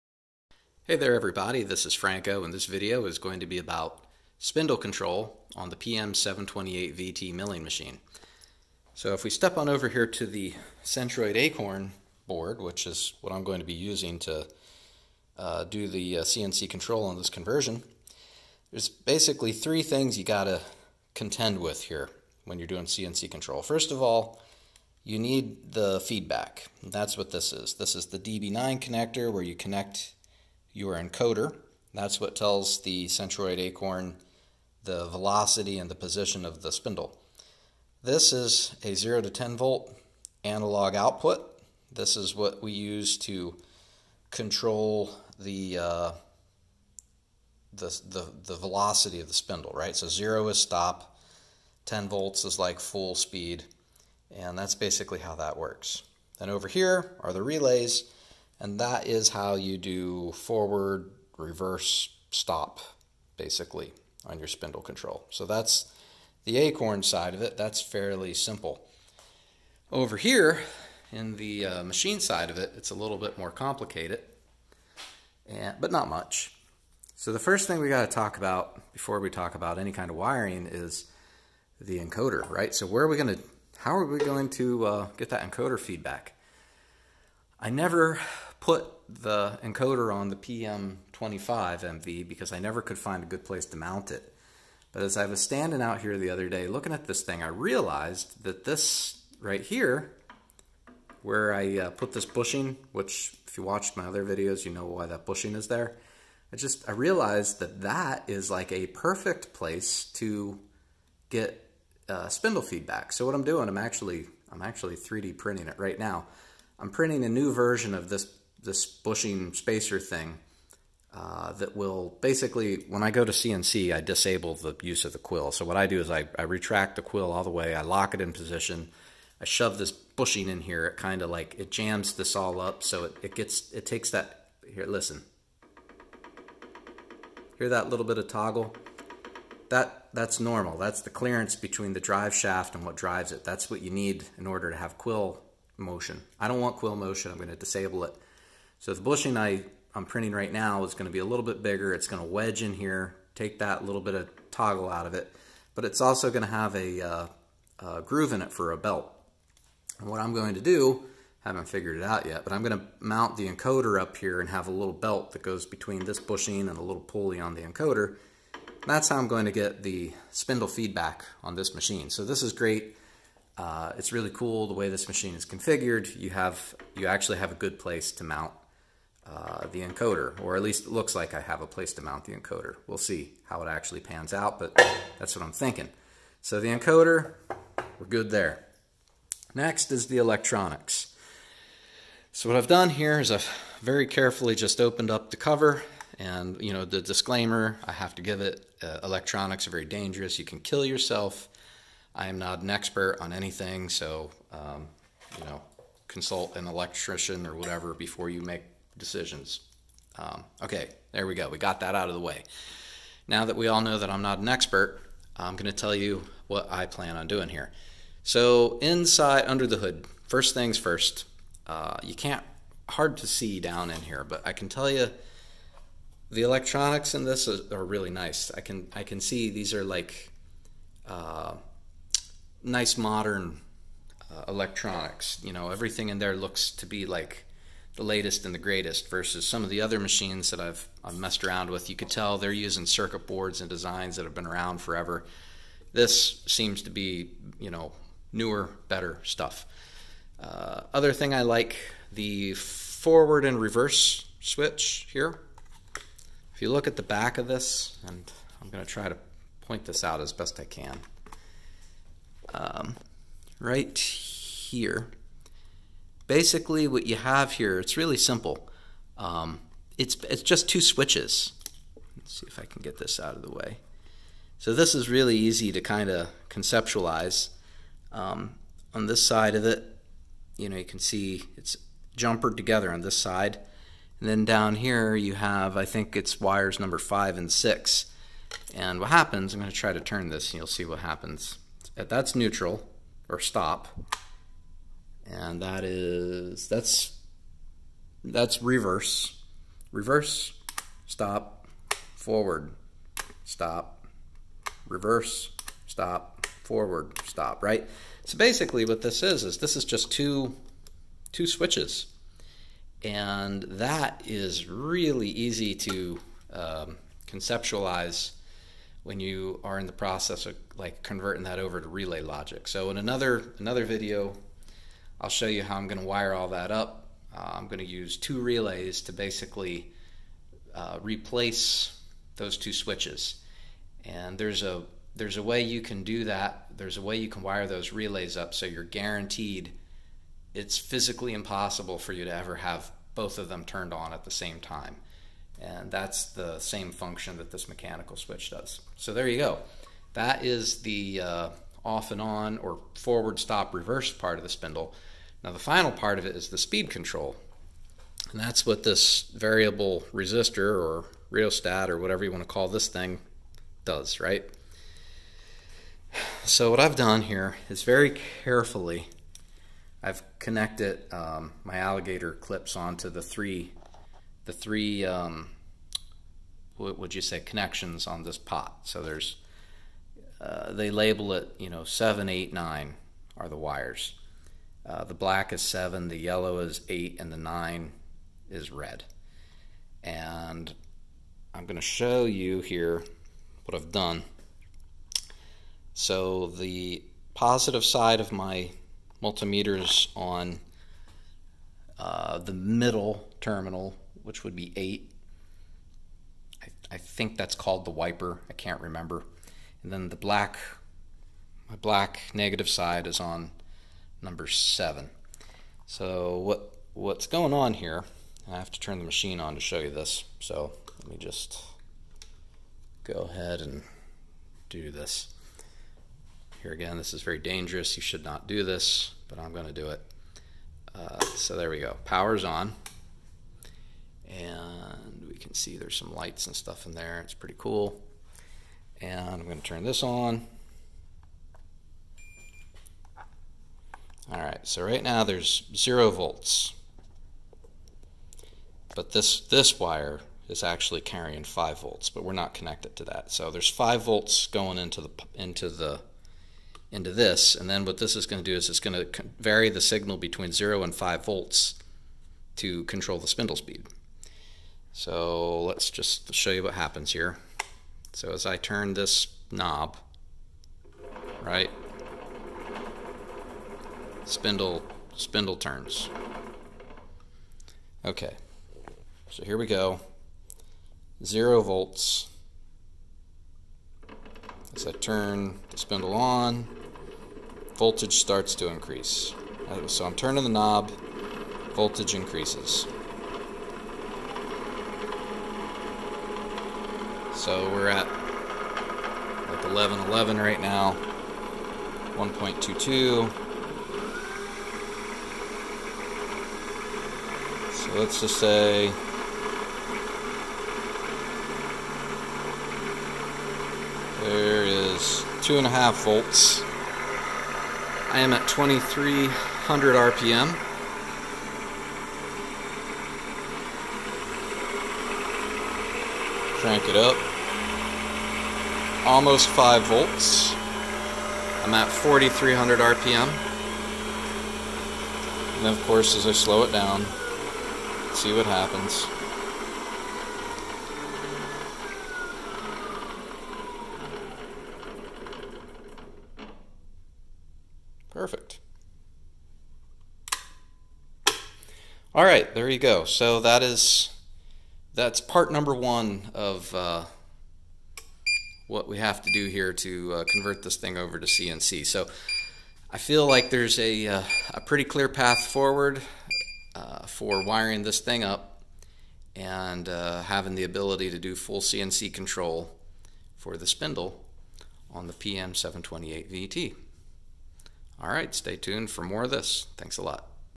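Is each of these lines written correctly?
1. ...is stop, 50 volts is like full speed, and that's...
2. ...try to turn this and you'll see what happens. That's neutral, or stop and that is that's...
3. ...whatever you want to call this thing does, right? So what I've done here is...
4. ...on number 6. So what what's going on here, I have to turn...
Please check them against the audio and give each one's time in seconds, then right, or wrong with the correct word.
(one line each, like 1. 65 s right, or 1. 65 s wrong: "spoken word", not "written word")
1. 50 s wrong: "10", not "50"
2. 289 s right
3. 361 s right
4. 413 s wrong: "7", not "6".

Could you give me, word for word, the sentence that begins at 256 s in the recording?
If you look at the back of this, and I'm going to try to point this out as best I can.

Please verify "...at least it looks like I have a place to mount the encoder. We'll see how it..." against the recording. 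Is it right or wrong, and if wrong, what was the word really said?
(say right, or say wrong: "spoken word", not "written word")
right.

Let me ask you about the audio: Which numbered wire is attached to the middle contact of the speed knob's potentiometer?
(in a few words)
8.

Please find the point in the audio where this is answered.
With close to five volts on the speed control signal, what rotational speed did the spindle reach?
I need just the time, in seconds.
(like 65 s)
531 s.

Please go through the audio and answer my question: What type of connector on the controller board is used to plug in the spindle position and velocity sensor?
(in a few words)
DB9.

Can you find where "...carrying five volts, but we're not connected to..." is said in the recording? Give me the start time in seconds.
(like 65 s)
451 s.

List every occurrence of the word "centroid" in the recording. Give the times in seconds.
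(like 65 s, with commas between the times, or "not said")
10 s, 33 s.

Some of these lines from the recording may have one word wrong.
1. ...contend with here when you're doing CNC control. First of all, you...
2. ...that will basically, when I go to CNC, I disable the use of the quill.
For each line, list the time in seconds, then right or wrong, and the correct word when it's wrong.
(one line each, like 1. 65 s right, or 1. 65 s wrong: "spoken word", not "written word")
1. 21 s right
2. 121 s right.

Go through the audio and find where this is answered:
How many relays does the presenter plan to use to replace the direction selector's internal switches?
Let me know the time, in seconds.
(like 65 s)
328 s.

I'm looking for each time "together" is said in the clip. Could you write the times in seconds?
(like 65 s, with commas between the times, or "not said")
282 s.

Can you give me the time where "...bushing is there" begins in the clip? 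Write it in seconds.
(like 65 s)
105 s.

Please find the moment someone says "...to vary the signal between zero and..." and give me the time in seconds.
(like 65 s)
458 s.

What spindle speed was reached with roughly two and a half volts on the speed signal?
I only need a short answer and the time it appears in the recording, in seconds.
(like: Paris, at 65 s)
2300 RPM, at 518 s.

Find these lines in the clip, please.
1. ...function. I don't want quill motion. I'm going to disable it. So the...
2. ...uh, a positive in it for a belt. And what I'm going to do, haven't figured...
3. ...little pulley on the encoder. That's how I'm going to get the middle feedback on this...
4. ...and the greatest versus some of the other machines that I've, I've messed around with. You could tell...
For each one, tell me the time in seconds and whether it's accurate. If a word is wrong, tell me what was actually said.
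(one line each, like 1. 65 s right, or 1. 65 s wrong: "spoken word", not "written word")
1. 145 s wrong: "motion", not "function"
2. 157 s wrong: "groove", not "positive"
3. 166 s wrong: "spindle", not "middle"
4. 238 s right.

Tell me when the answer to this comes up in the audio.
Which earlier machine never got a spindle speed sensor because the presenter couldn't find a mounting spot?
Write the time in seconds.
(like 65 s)
90 s.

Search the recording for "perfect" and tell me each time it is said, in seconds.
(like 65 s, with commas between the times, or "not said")
108 s, 548 s.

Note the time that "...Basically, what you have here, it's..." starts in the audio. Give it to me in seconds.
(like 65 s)
266 s.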